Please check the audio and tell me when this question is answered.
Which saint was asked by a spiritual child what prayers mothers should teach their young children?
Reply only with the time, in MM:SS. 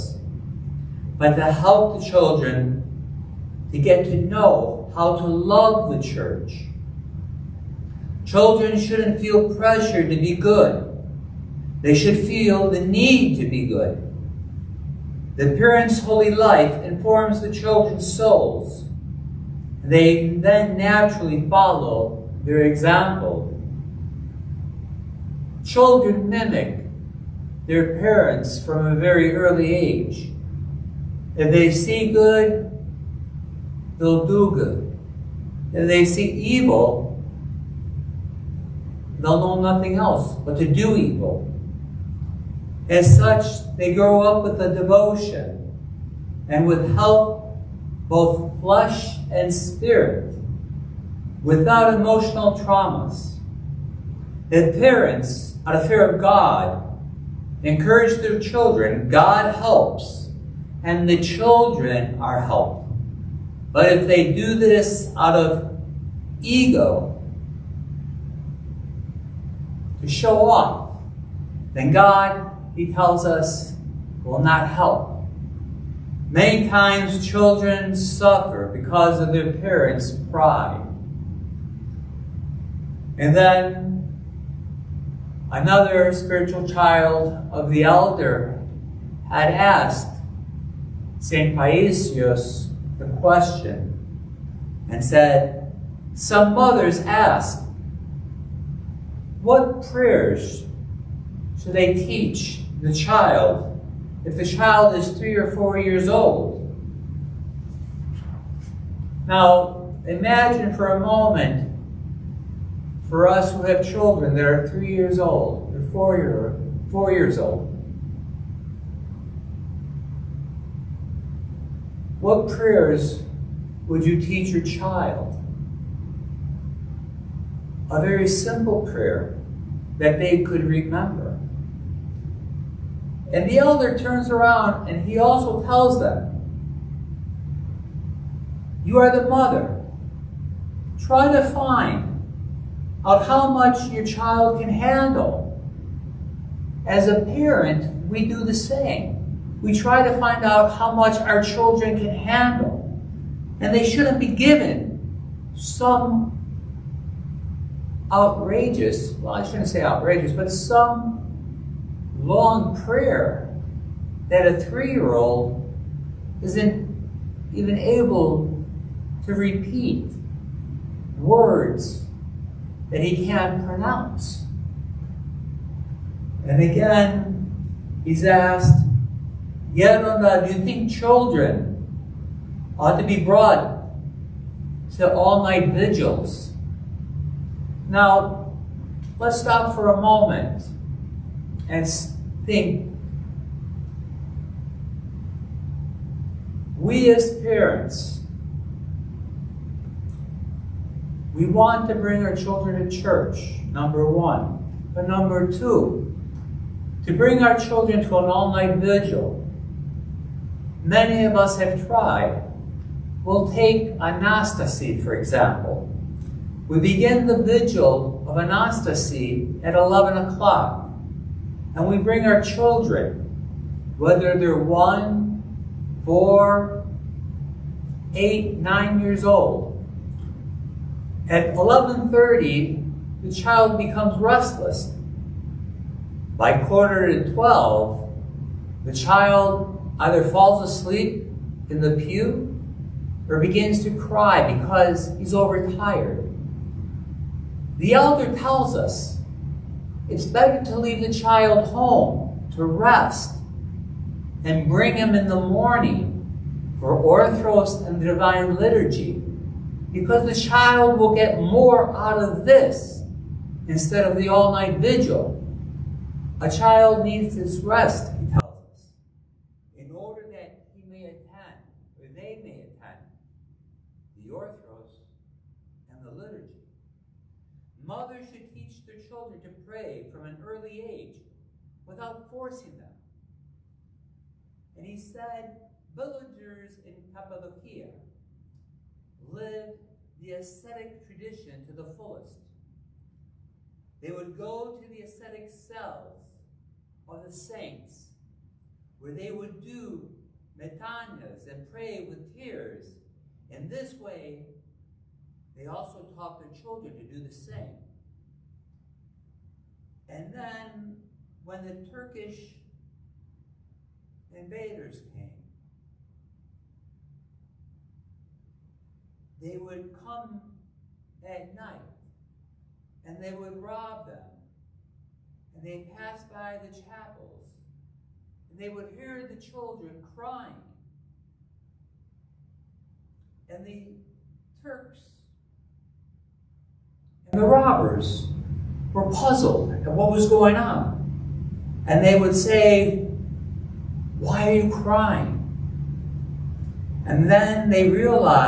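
01:31.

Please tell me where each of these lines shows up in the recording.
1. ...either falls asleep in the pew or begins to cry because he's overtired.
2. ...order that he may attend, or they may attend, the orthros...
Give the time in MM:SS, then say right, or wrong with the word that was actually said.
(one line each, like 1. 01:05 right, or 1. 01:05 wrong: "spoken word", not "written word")
1. 03:59 right
2. 04:29 right.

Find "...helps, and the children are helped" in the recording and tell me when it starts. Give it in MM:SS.
00:59.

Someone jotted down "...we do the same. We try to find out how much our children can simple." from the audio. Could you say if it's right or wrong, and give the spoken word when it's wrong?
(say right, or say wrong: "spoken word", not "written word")
wrong: "handle", not "simple".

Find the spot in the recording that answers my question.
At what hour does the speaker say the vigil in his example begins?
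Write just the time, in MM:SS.
03:39.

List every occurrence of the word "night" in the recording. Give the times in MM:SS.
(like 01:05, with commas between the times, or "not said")
03:05, 03:28, 04:24, 05:21.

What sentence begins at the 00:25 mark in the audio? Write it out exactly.
Children mimic their parents from a very early age.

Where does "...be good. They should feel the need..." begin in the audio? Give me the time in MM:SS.
00:10.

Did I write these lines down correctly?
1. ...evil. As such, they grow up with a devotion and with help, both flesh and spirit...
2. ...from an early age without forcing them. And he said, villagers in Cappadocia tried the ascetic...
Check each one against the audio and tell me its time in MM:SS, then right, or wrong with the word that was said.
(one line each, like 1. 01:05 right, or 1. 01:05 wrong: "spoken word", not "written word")
1. 00:40 right
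2. 04:40 wrong: "lived", not "tried".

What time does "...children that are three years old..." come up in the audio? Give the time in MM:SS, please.
01:53.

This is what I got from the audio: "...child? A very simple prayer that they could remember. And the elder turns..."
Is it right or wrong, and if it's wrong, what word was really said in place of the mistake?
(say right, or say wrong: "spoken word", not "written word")
right.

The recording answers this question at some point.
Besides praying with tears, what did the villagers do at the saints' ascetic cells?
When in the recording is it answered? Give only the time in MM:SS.
05:00.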